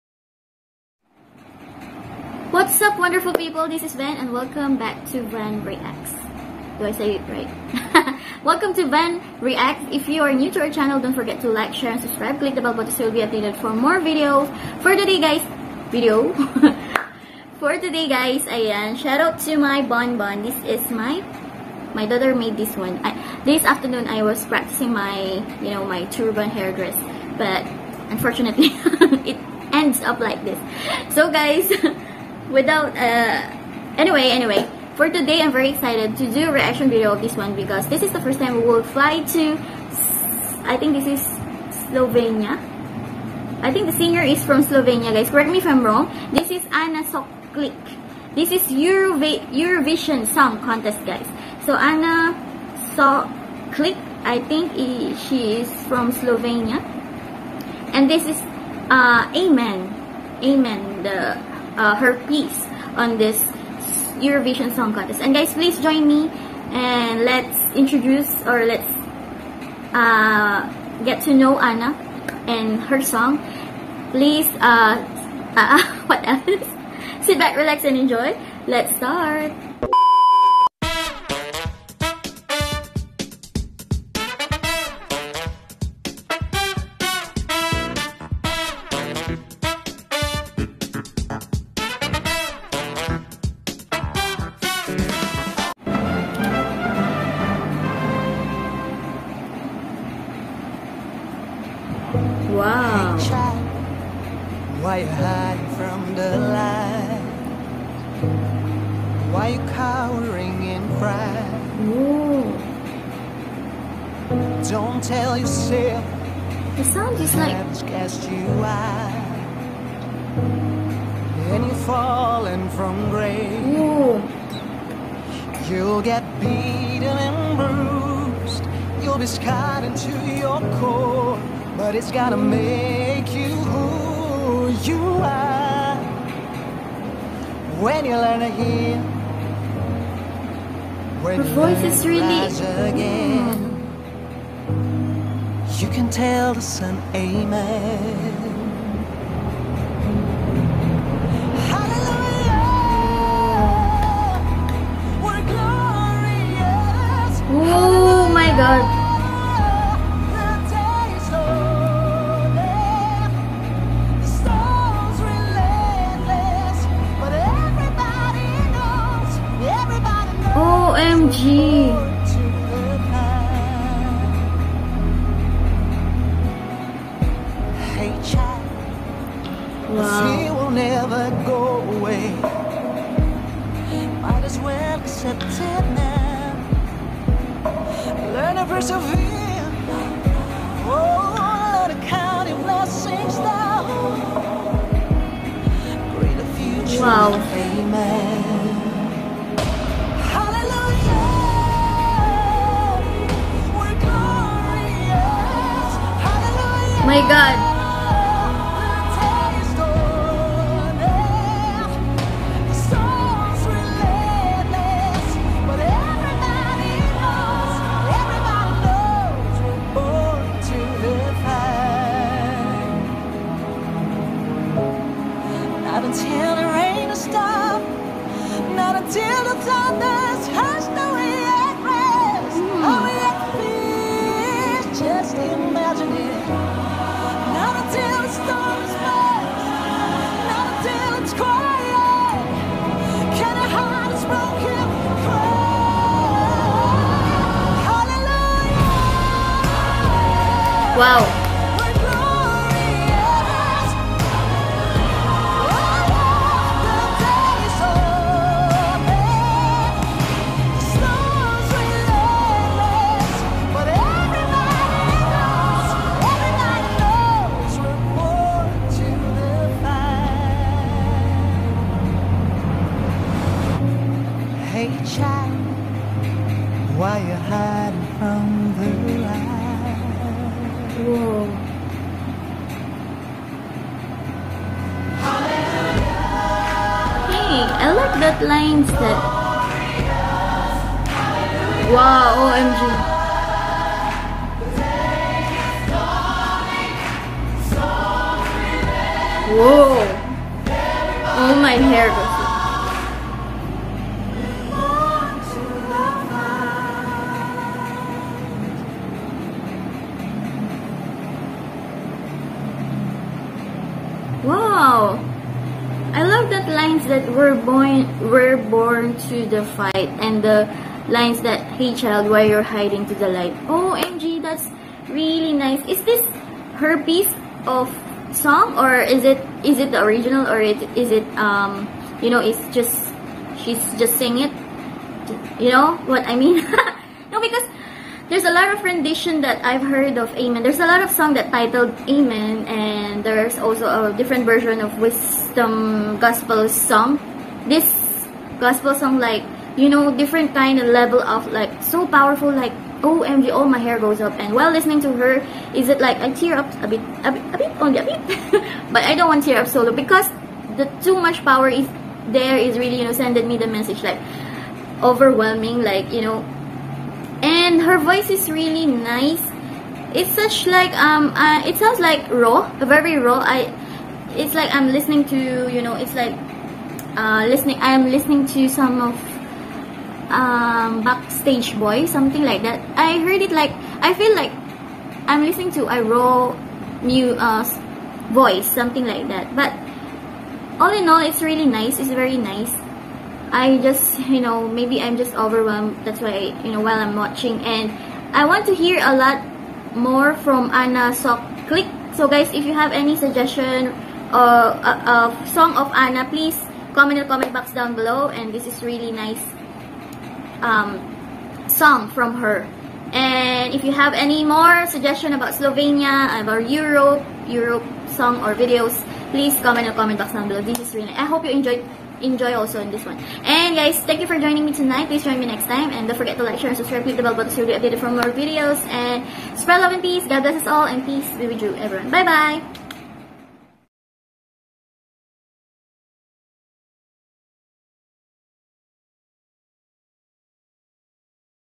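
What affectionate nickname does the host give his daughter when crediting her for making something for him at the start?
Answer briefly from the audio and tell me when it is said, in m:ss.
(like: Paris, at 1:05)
bonbon, at 0:19.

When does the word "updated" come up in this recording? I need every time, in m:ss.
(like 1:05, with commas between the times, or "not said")
0:13, 7:07.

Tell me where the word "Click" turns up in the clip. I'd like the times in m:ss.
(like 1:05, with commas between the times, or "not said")
0:12, 6:41, 7:07.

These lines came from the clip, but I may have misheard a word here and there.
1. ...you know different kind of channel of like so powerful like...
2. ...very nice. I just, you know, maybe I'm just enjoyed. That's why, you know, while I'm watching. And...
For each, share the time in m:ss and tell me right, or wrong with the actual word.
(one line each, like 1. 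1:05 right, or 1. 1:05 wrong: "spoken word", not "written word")
1. 5:49 wrong: "level", not "channel"
2. 6:32 wrong: "overwhelmed", not "enjoyed".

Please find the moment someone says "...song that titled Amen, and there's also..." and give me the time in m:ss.
5:41.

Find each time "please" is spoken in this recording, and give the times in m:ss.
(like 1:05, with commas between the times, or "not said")
1:05, 1:14, 6:46, 6:59, 7:05.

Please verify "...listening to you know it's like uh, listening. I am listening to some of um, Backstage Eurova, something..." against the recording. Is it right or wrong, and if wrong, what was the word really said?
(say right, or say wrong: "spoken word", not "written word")
wrong: "Boy", not "Eurova".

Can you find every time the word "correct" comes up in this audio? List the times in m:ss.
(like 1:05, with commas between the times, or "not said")
0:45.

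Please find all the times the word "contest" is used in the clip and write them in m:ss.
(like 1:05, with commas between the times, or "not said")
0:50, 1:04.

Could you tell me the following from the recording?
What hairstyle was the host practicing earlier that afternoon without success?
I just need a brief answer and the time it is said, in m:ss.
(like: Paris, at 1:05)
turban hairdress, at 0:26.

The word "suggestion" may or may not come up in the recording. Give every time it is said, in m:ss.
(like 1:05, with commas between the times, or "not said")
6:43, 6:54.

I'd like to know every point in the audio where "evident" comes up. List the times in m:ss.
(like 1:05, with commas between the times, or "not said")
not said.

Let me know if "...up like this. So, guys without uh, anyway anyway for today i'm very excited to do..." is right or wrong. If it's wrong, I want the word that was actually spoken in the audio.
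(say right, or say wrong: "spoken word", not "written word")
right.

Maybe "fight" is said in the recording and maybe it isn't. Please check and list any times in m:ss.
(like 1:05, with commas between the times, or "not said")
5:19.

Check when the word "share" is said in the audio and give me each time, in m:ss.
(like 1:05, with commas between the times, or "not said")
0:11, 7:06.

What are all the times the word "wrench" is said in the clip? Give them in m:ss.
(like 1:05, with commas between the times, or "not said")
not said.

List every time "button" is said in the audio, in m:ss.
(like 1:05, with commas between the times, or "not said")
0:12, 7:07.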